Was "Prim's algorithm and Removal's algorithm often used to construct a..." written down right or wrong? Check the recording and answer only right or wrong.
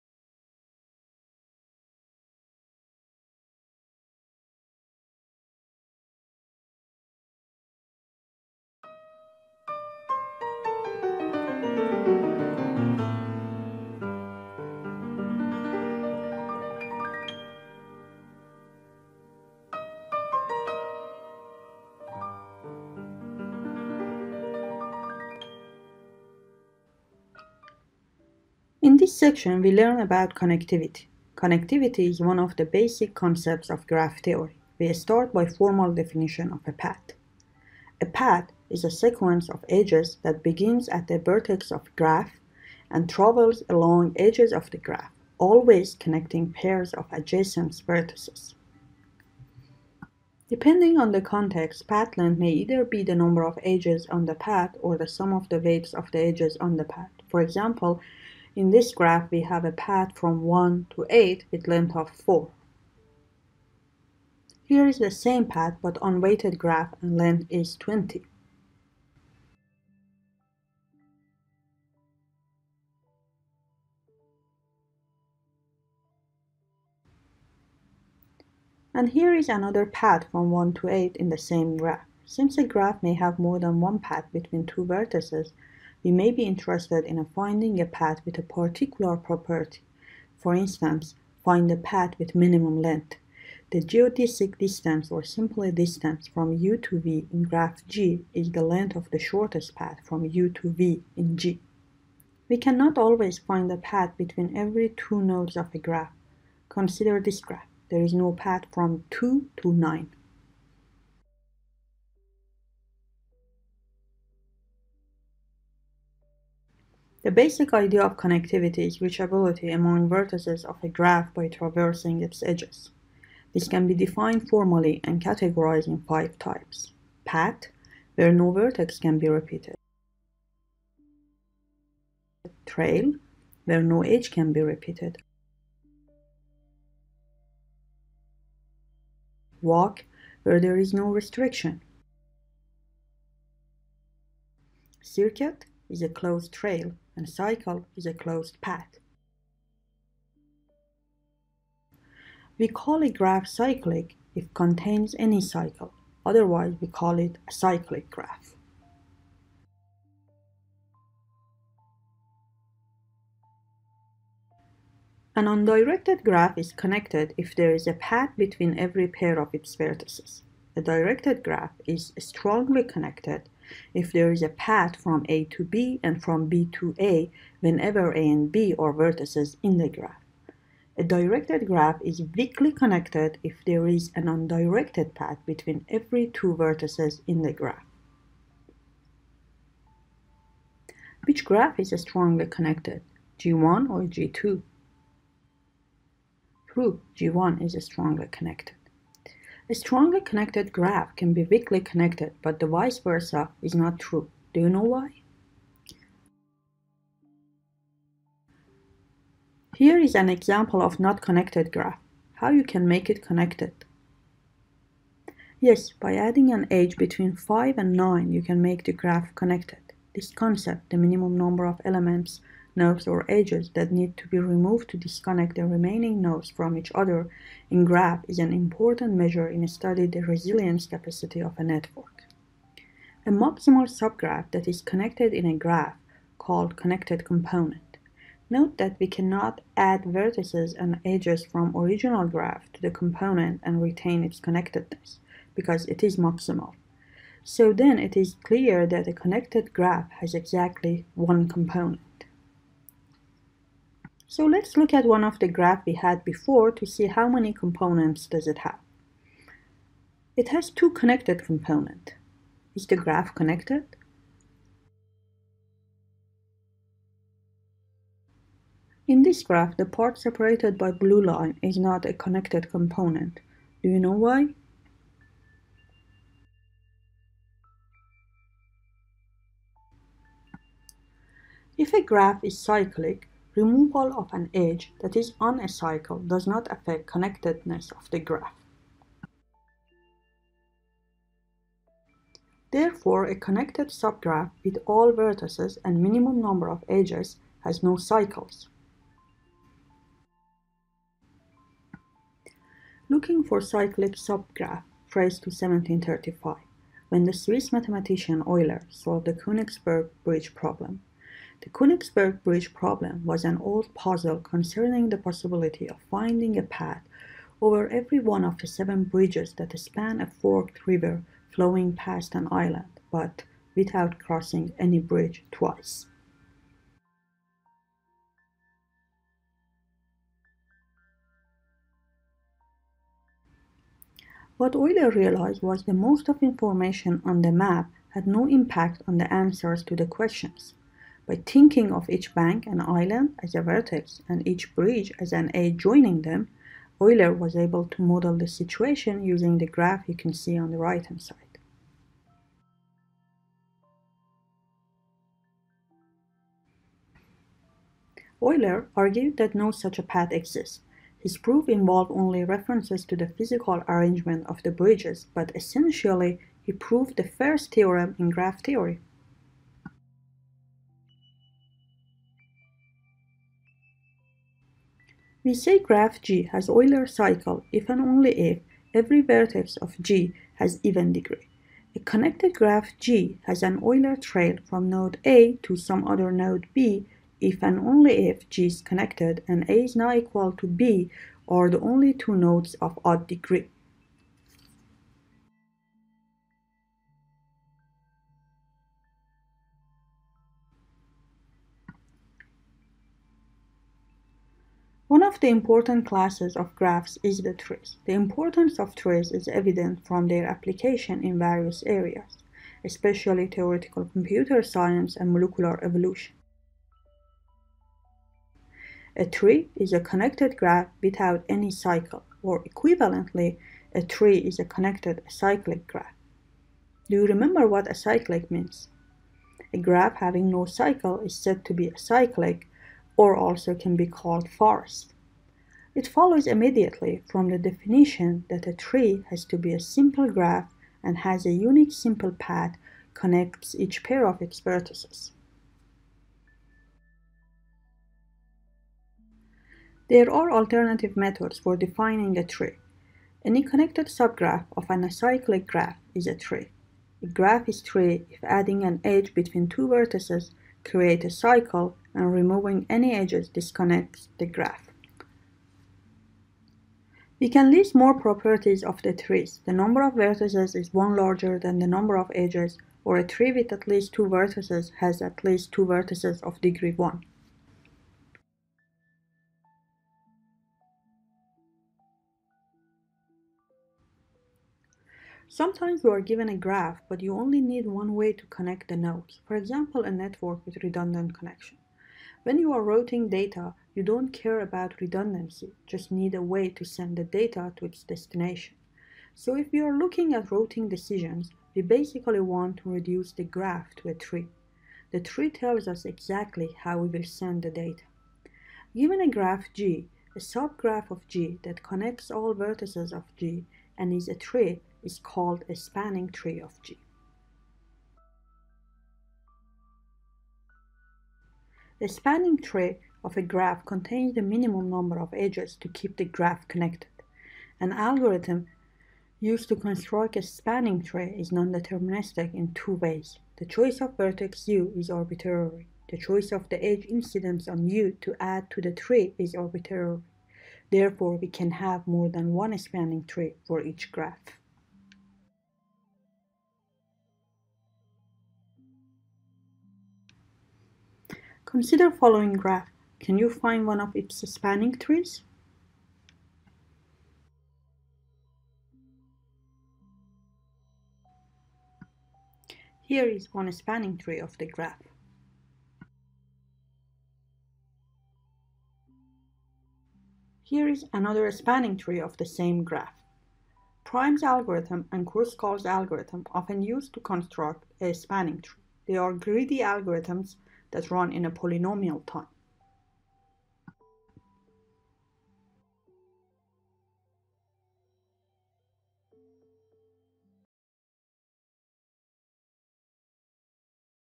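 wrong.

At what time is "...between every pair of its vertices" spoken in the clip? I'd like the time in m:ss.
2:48.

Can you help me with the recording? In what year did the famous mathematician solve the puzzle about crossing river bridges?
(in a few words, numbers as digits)
1735.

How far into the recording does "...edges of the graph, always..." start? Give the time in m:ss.
0:44.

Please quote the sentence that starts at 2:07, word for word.
Path, where no vertex can be repeated.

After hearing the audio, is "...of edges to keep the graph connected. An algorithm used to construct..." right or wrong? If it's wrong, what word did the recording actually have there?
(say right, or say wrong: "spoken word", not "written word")
right.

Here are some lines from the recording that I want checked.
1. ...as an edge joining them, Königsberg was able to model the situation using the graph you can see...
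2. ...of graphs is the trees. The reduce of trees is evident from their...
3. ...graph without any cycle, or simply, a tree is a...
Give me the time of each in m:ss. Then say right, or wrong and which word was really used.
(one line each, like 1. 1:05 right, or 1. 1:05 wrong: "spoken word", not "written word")
1. 5:45 wrong: "Euler", not "Königsberg"
2. 6:46 wrong: "importance", not "reduce"
3. 7:00 wrong: "equivalently", not "simply".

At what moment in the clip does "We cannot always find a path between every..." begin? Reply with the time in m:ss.
1:42.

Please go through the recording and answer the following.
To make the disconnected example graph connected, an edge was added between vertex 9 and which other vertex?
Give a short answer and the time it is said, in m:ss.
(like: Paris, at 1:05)
5, at 3:37.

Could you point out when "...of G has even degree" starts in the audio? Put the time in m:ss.
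6:19.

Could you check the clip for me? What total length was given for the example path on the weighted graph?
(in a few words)
20.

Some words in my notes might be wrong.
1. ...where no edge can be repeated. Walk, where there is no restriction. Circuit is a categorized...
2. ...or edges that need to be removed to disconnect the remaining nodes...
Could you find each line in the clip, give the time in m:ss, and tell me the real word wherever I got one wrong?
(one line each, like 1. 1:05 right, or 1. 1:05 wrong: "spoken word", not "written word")
1. 2:13 wrong: "closed", not "categorized"
2. 3:43 right.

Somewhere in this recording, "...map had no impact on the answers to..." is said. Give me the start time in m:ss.
5:37.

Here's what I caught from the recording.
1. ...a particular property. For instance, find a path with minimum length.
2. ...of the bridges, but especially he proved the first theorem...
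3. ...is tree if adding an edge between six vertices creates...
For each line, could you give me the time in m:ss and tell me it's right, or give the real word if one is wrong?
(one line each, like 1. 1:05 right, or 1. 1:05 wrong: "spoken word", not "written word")
1. 1:28 right
2. 6:04 wrong: "essentially", not "especially"
3. 7:37 wrong: "two", not "six".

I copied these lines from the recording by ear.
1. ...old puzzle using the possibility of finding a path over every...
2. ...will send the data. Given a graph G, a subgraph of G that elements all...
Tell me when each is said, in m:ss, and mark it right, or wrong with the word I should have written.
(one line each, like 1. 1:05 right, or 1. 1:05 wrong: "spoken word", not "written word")
1. 5:13 wrong: "concerning", not "using"
2. 8:27 wrong: "connects", not "elements".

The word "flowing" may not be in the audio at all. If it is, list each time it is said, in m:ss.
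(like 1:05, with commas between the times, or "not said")
5:21.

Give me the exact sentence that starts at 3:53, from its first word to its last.
A maximal subgraph that is connected in a graph called connected component.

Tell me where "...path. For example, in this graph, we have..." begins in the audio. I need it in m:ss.
0:56.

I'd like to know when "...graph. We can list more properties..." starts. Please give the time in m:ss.
7:44.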